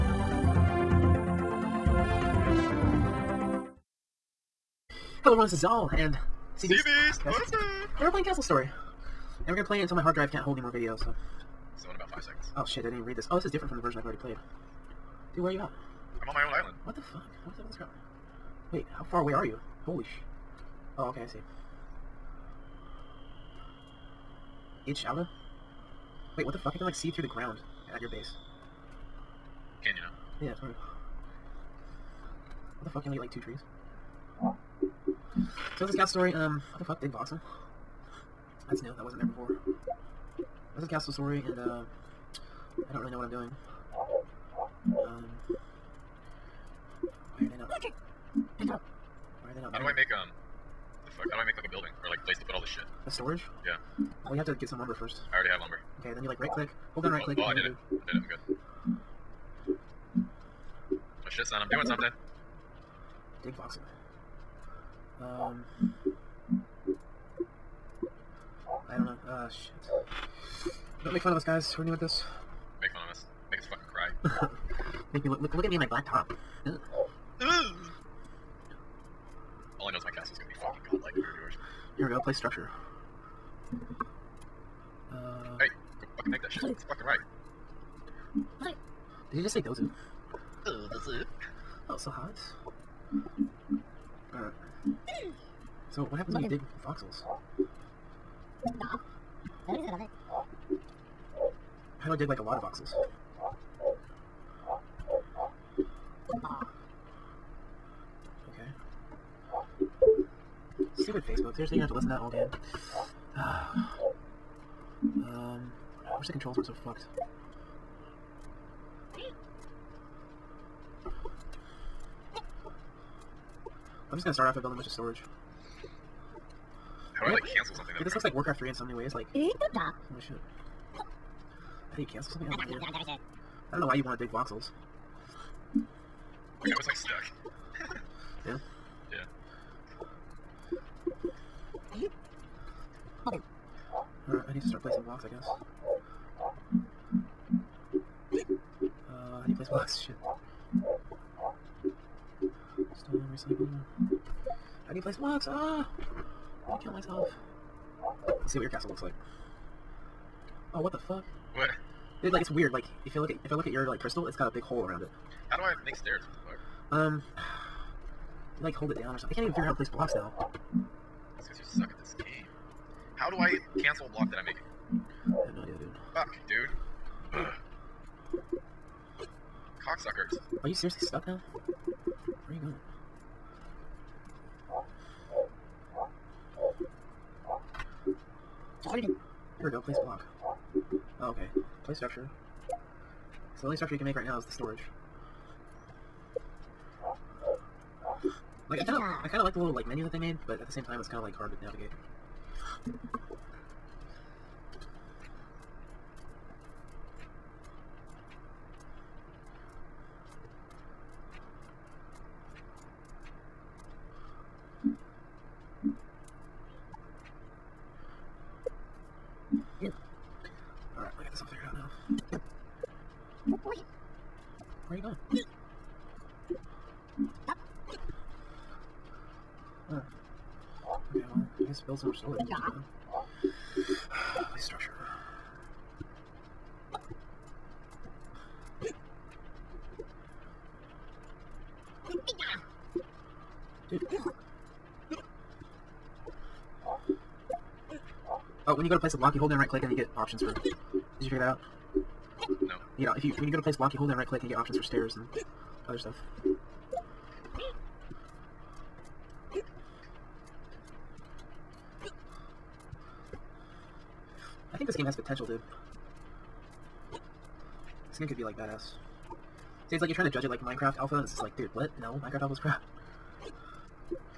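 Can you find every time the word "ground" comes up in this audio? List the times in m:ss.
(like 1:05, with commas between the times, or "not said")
0:27.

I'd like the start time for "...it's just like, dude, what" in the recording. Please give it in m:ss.
4:31.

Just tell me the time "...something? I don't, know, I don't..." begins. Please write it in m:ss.
2:12.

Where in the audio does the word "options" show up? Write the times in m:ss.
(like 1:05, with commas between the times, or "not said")
4:10, 4:14.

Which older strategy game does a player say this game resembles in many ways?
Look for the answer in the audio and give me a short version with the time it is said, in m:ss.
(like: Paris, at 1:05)
Warcraft 3, at 2:08.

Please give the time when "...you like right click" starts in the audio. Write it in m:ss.
0:56.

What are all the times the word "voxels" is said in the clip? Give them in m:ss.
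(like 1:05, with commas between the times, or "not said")
0:37, 1:03, 1:36, 1:42, 2:14.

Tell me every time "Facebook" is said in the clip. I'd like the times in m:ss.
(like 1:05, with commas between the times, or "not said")
1:51.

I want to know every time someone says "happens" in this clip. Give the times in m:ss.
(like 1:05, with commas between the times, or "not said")
1:36.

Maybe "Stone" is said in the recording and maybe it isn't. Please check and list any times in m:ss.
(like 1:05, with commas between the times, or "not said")
2:32.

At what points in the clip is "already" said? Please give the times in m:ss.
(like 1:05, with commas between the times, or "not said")
0:14, 0:55.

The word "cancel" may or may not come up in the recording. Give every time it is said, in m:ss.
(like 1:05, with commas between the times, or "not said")
2:12, 2:53.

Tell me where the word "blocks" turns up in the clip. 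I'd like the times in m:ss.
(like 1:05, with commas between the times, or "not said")
2:25, 2:29, 2:35, 2:49, 2:54, 3:10, 4:09, 4:13.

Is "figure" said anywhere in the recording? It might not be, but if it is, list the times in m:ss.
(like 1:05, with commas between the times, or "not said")
2:49, 4:11.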